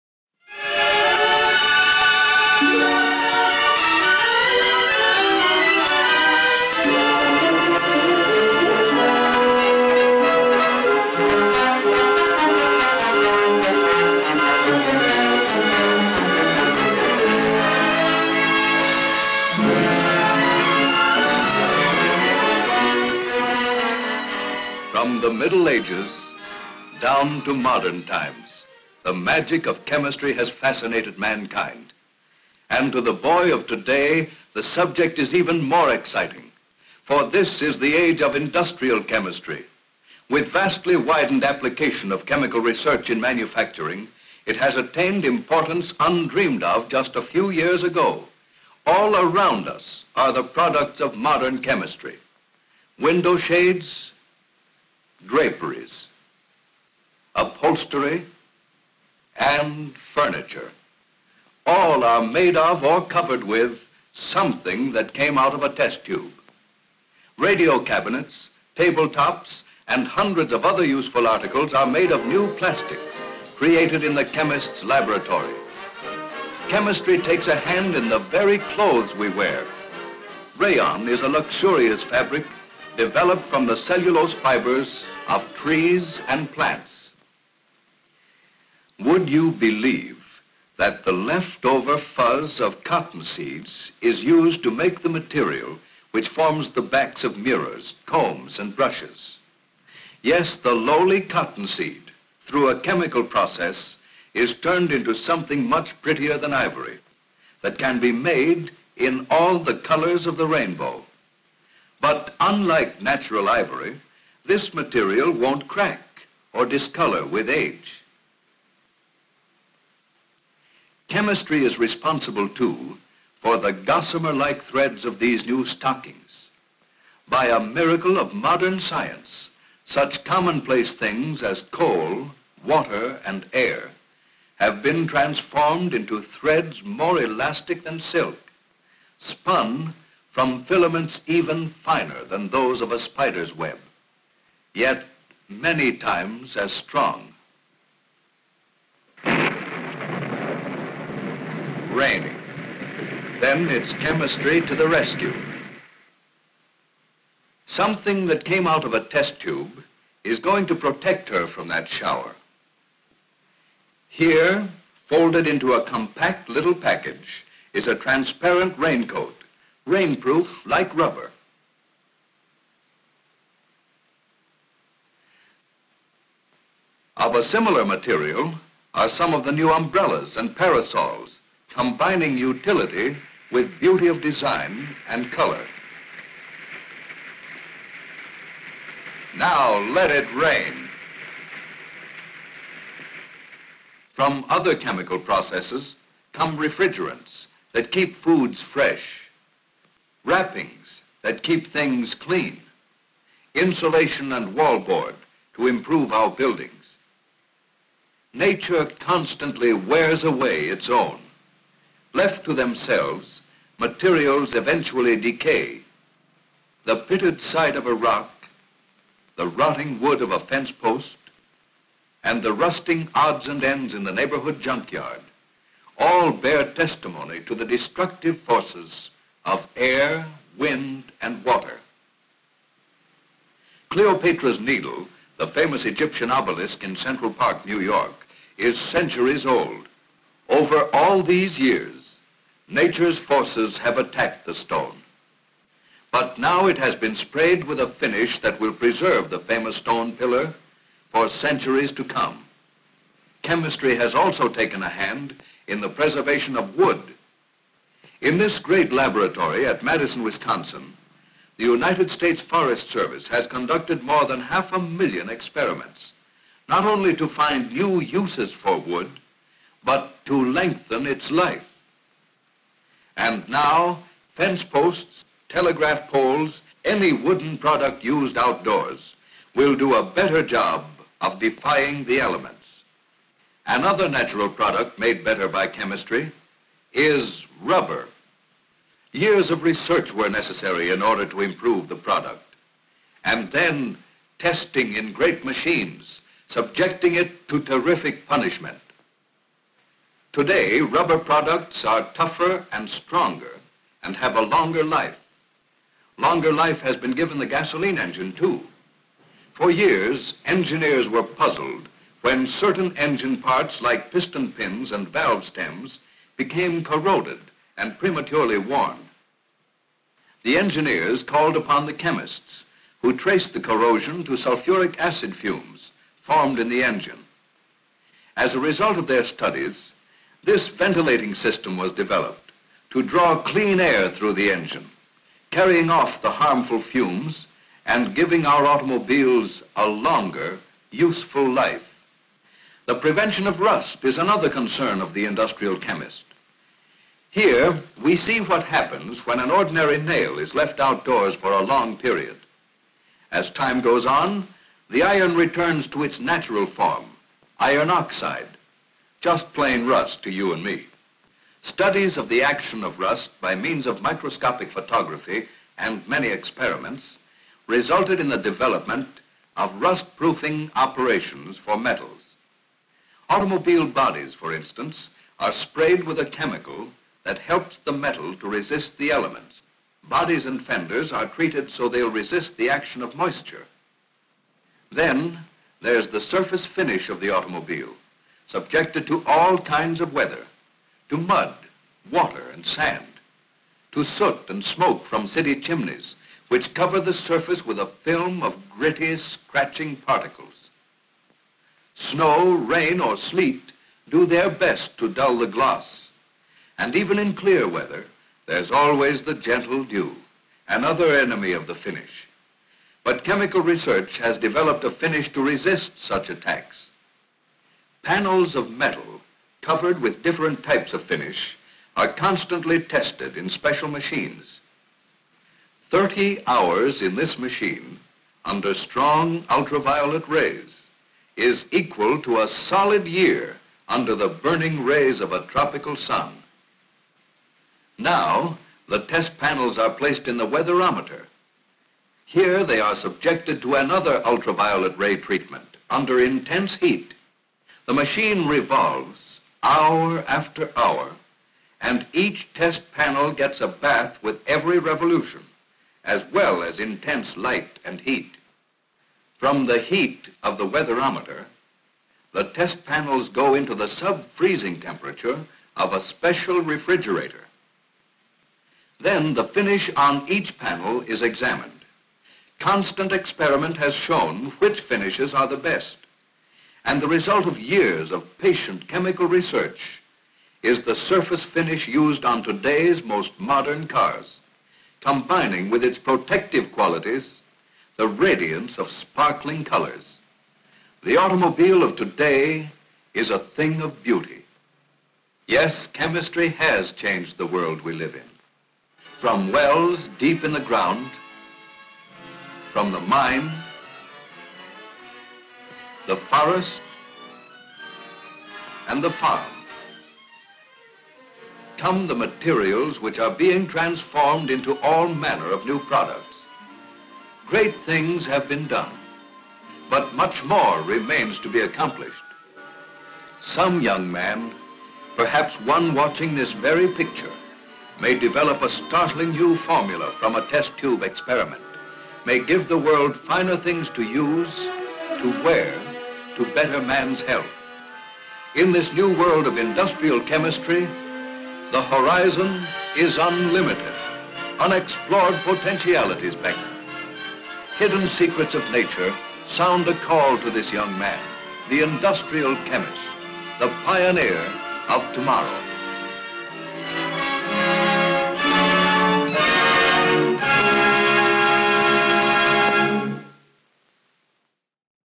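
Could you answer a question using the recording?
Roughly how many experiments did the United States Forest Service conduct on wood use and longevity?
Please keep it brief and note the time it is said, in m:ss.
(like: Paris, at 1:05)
More than half a million, at 4:24.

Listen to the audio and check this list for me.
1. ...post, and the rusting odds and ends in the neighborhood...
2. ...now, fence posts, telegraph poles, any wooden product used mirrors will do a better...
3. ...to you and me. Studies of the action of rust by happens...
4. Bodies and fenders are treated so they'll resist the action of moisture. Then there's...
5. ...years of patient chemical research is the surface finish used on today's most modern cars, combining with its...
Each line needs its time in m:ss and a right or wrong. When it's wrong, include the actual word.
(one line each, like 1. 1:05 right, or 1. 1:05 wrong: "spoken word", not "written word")
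1. 3:40 right
2. 4:33 wrong: "outdoors", not "mirrors"
3. 6:00 wrong: "means", not "happens"
4. 6:20 right
5. 7:57 right.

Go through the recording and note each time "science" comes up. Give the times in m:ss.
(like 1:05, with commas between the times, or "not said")
2:08.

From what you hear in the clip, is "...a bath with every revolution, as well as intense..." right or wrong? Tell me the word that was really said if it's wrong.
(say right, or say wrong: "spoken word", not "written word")
right.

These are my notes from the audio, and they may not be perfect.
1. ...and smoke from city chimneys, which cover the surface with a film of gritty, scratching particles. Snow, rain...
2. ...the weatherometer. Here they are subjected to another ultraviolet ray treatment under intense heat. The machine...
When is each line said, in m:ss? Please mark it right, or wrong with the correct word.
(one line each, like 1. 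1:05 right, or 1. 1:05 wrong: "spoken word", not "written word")
1. 6:34 right
2. 7:20 right.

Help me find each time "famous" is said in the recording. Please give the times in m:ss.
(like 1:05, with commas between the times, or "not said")
3:55, 4:09.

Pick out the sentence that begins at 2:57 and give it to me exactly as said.
Of a similar material are some of the new umbrellas and parasols, combining utility with beauty of design and color.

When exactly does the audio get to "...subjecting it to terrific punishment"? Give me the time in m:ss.
4:56.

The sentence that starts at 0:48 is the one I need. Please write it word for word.
All around us are the products of modern chemistry.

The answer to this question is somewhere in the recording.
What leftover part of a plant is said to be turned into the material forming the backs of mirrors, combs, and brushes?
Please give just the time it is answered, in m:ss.
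1:31.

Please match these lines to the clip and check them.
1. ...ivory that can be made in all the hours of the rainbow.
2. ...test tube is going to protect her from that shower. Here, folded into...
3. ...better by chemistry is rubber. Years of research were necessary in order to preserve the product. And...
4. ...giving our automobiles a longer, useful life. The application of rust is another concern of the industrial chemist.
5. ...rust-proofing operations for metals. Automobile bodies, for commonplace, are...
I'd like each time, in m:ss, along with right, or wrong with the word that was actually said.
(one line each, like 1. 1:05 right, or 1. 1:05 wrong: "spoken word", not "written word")
1. 1:46 wrong: "colors", not "hours"
2. 2:39 right
3. 4:45 wrong: "improve", not "preserve"
4. 5:38 wrong: "prevention", not "application"
5. 6:09 wrong: "instance", not "commonplace".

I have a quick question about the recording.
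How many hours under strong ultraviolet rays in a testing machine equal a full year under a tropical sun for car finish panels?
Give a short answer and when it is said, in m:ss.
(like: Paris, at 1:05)
30, at 7:05.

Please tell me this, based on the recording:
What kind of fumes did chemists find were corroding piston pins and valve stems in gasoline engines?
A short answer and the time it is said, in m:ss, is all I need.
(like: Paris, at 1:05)
Sulfuric acid fumes, at 5:24.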